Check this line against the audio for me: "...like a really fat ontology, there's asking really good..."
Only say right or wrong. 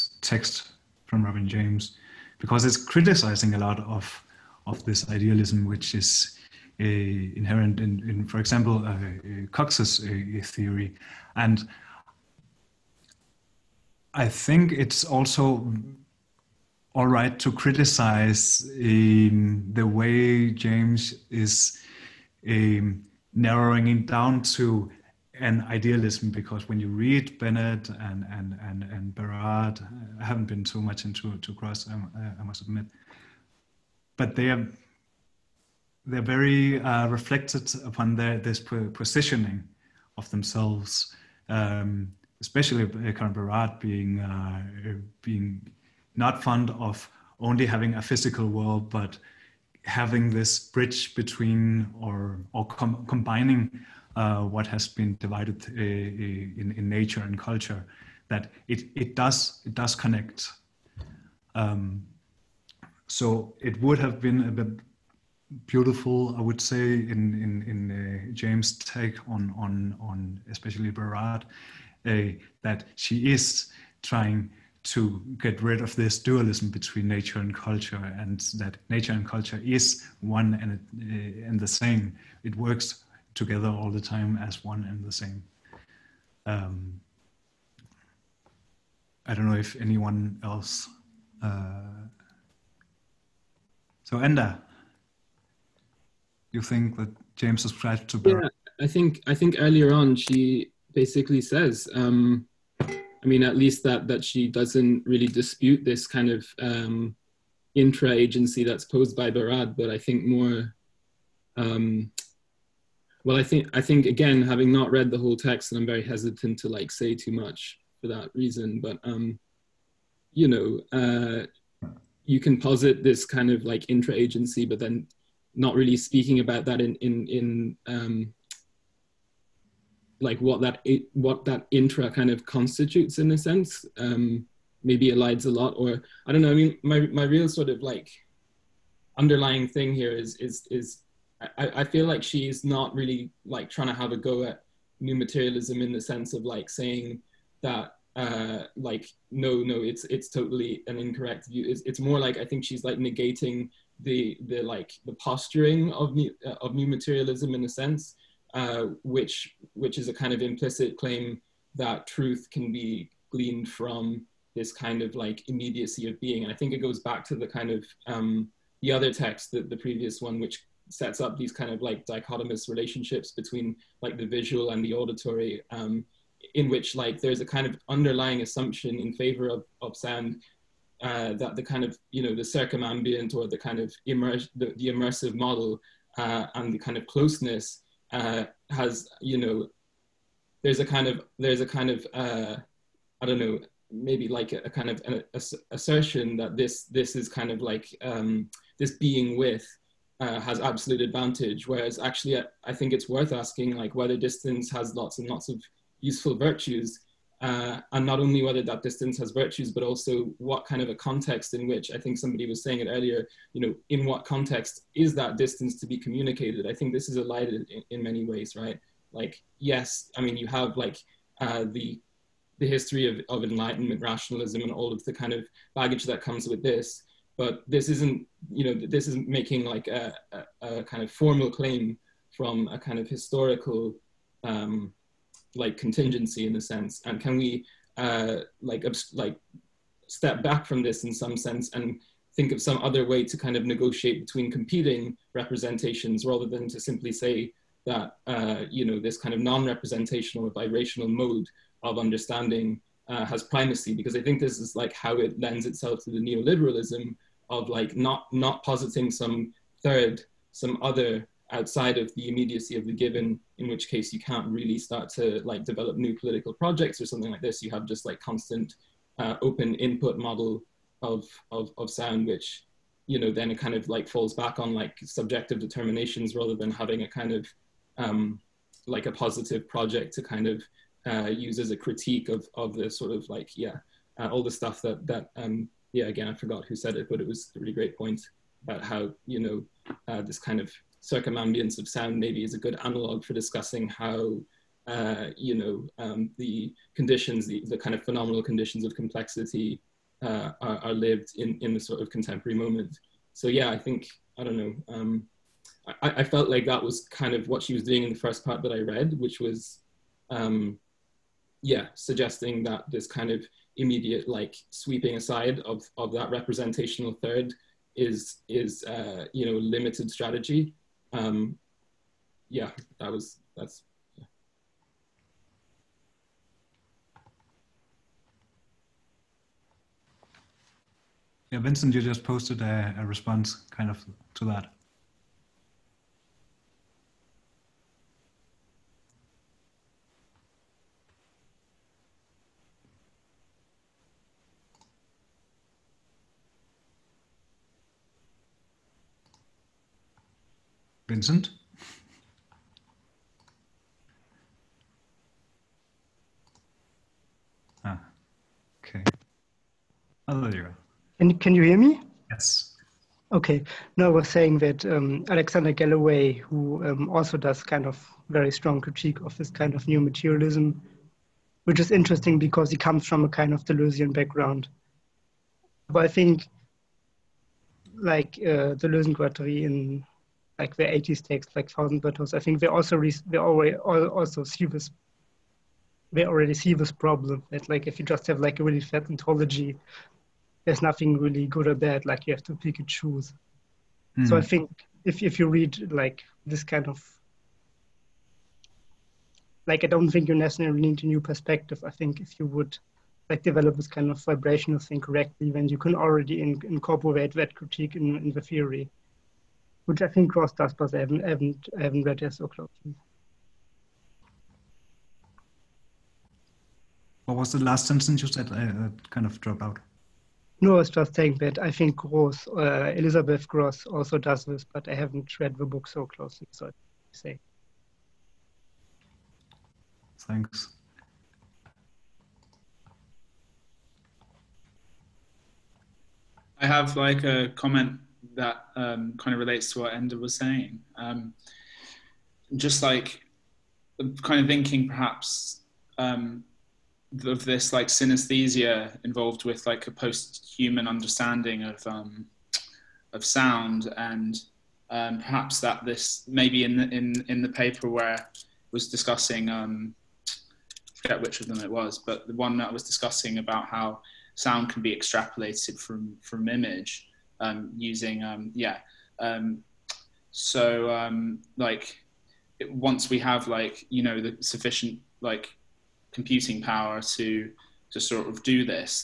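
wrong.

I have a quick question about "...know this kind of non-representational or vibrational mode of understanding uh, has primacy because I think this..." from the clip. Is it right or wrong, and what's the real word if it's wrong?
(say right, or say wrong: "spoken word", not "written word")
right.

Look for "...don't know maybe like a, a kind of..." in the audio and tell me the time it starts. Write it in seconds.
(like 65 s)
193 s.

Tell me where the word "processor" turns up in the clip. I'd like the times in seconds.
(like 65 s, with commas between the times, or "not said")
not said.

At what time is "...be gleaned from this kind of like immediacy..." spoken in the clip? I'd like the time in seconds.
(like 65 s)
162 s.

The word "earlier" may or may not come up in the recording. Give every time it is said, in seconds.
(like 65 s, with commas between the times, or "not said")
99 s, 212 s.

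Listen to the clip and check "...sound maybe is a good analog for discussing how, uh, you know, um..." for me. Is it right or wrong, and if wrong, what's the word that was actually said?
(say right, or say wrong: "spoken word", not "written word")
right.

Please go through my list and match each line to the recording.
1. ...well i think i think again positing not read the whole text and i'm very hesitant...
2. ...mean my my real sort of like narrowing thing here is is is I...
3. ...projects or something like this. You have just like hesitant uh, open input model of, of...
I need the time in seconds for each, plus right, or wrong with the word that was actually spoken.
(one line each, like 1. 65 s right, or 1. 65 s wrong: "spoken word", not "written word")
1. 113 s wrong: "having", not "positing"
2. 136 s wrong: "underlying", not "narrowing"
3. 266 s wrong: "constant", not "hesitant".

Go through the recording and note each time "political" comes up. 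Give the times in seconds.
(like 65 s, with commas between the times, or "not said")
266 s.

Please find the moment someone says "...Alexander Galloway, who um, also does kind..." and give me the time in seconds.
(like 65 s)
365 s.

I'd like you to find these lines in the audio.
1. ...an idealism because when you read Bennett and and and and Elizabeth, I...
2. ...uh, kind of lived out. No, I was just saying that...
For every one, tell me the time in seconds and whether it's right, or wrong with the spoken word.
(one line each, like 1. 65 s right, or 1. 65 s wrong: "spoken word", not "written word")
1. 25 s wrong: "Barad", not "Elizabeth"
2. 418 s wrong: "dropped", not "lived".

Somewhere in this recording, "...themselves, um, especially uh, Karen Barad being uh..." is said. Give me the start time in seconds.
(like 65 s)
40 s.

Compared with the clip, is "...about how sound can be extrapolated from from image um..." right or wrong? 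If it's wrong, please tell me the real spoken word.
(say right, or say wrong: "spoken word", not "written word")
right.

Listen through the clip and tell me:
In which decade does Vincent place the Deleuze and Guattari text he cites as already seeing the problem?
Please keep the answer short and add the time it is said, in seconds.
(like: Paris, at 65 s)
1980s, at 380 s.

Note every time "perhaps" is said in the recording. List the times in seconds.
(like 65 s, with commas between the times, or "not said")
444 s, 455 s.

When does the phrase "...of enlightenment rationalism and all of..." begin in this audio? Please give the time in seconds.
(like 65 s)
223 s.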